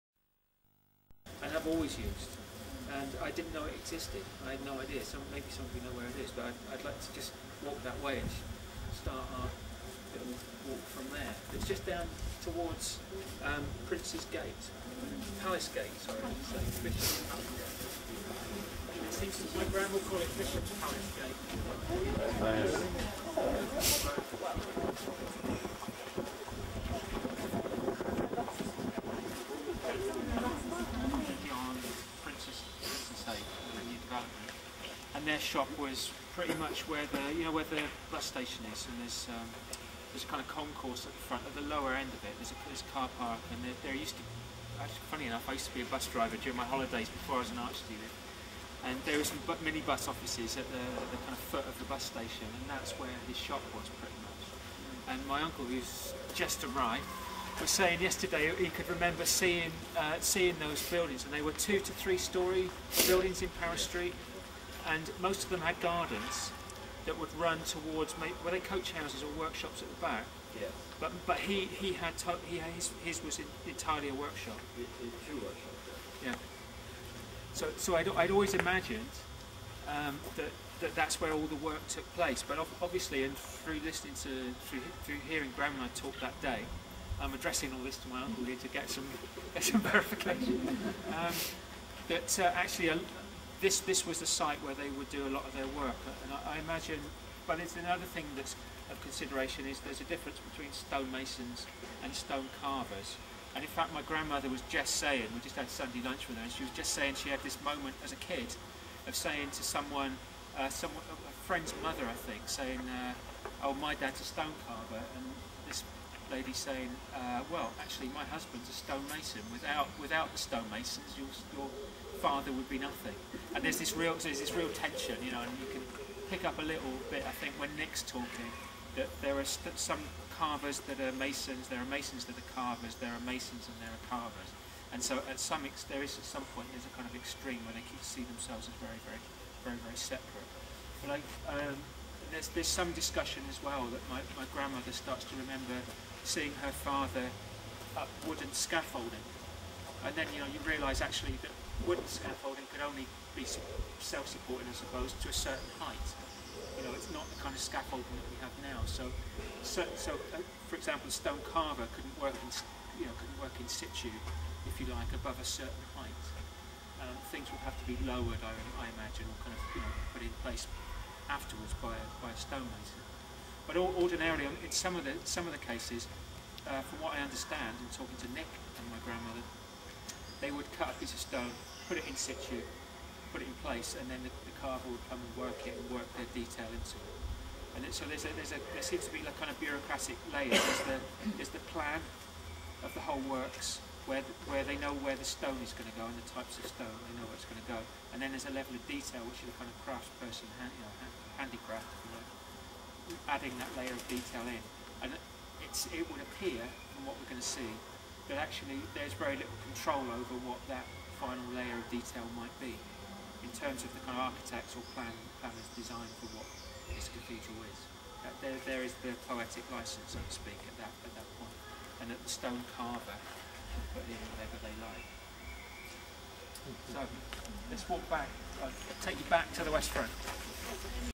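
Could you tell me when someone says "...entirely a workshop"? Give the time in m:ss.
1:13.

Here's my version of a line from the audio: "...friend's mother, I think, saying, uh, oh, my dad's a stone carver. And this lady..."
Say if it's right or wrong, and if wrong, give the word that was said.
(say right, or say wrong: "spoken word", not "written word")
right.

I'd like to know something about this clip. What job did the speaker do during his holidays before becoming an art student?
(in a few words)
Bus driver.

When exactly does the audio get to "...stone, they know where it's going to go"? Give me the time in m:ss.
3:16.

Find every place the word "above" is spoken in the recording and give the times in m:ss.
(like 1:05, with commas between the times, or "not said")
2:45.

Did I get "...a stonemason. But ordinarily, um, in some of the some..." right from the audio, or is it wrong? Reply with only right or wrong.
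right.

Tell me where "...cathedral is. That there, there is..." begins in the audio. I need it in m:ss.
3:37.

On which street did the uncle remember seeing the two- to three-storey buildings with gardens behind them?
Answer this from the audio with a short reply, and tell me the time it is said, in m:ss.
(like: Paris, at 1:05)
Paris Street, at 1:03.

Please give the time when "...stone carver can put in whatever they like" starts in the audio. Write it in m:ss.
3:42.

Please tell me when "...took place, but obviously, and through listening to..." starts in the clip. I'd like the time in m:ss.
1:21.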